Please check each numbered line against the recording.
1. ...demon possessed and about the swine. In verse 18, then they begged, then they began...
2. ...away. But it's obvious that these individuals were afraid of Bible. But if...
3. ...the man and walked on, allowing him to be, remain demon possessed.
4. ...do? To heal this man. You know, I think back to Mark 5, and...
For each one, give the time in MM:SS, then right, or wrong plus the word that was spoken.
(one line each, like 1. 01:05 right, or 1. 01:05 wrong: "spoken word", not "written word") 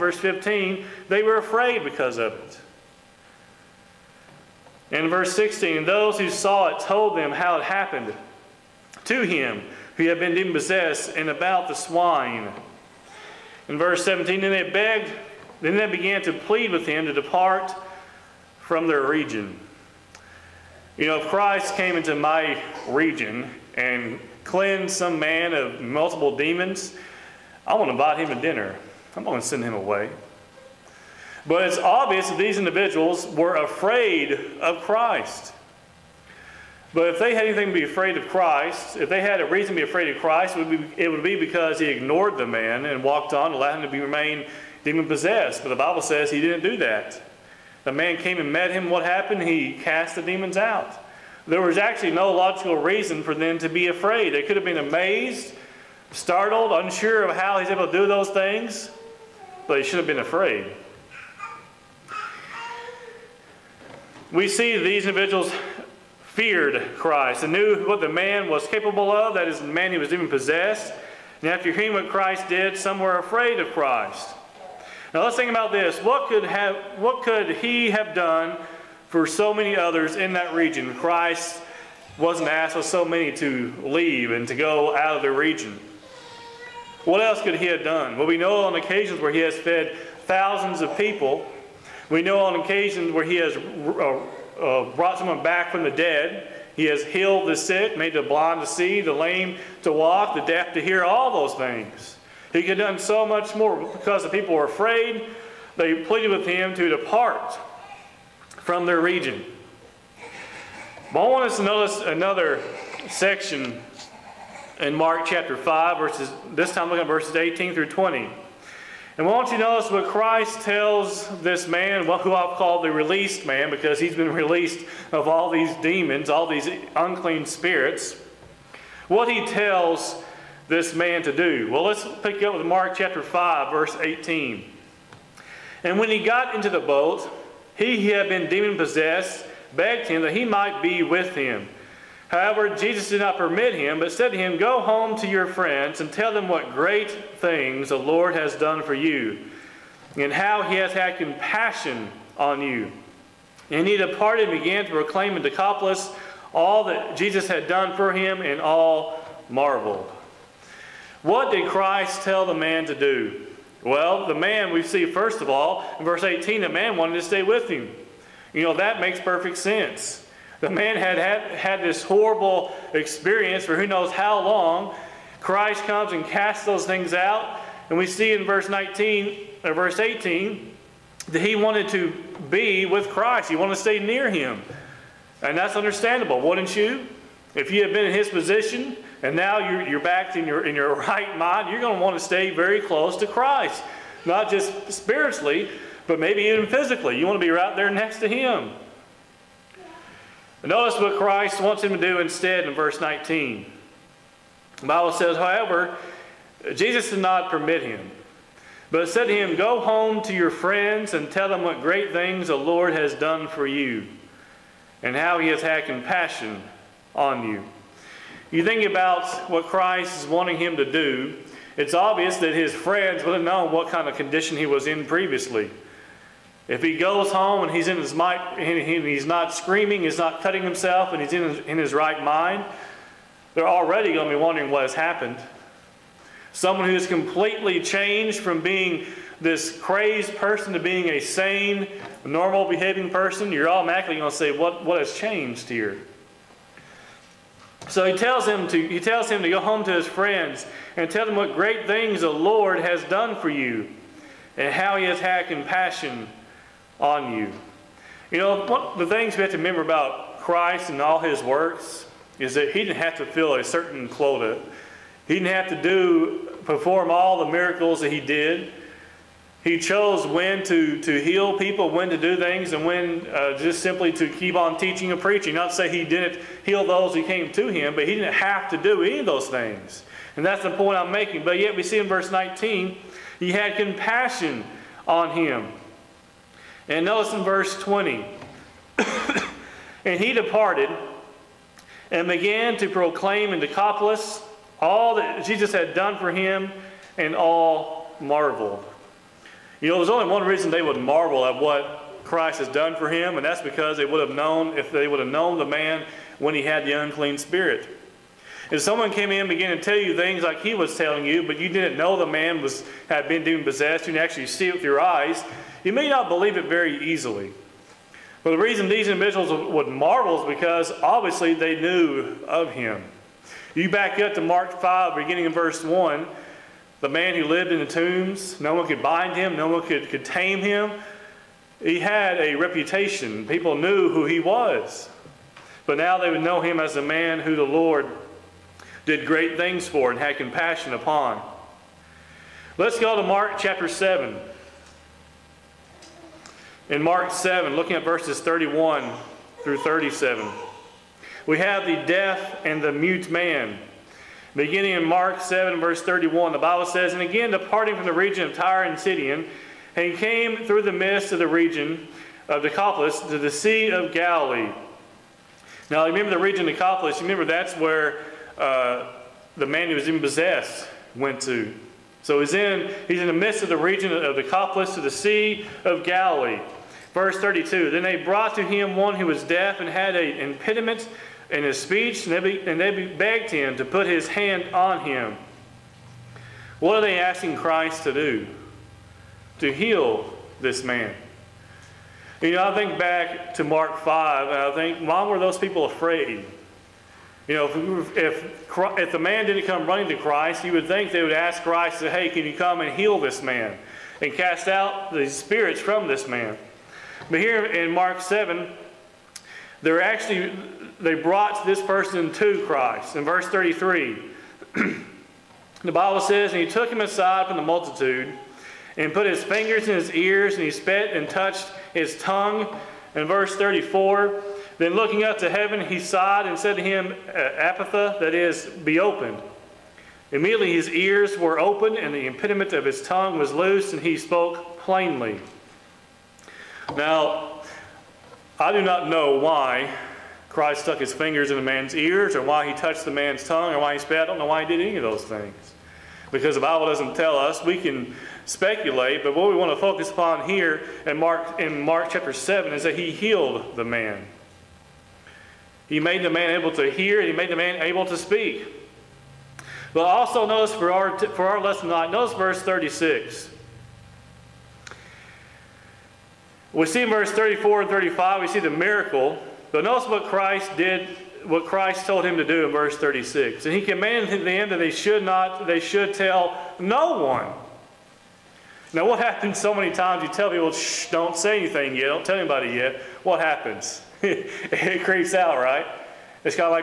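1. 00:10 wrong: "17", not "18"
2. 00:29 wrong: "Christ", not "Bible"
3. 00:42 right
4. 06:28 right.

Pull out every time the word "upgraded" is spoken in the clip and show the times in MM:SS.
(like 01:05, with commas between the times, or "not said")
not said.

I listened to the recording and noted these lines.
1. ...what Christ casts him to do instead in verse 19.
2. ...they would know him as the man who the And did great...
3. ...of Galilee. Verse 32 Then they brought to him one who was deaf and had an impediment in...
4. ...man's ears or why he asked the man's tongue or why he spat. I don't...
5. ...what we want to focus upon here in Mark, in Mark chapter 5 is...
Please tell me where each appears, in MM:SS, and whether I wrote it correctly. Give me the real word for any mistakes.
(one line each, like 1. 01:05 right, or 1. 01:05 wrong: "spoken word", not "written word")
1. 03:20 wrong: "wants", not "casts"
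2. 05:36 wrong: "Lord", not "And"
3. 06:15 right
4. 07:21 wrong: "touched", not "asked"
5. 07:29 wrong: "7", not "5".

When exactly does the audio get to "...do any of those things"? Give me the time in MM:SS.
04:38.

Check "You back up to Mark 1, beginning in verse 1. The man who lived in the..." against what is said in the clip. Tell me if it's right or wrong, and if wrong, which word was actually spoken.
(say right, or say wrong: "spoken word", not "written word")
wrong: "5", not "1".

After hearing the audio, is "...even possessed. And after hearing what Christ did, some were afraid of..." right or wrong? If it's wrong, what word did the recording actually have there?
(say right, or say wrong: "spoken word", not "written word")
right.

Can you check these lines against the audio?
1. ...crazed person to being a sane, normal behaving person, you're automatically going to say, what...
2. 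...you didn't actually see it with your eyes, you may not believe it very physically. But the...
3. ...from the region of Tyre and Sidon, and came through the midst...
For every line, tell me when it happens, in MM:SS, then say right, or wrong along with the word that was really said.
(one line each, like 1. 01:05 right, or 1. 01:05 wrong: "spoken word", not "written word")
1. 03:59 right
2. 05:14 wrong: "easily", not "physically"
3. 05:57 right.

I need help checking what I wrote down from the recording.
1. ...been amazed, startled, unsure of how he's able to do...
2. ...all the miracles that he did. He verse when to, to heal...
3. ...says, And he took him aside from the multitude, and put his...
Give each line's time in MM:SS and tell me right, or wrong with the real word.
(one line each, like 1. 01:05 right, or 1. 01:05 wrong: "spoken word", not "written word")
1. 00:54 right
2. 04:27 wrong: "chose", not "verse"
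3. 06:56 right.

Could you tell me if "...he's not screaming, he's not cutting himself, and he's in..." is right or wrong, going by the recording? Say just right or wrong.
right.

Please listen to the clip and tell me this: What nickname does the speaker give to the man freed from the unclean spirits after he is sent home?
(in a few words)
the released man.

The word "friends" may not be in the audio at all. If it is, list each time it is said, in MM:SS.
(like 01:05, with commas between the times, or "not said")
02:25, 03:30, 03:42, 04:10.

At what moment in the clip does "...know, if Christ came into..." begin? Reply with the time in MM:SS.
00:21.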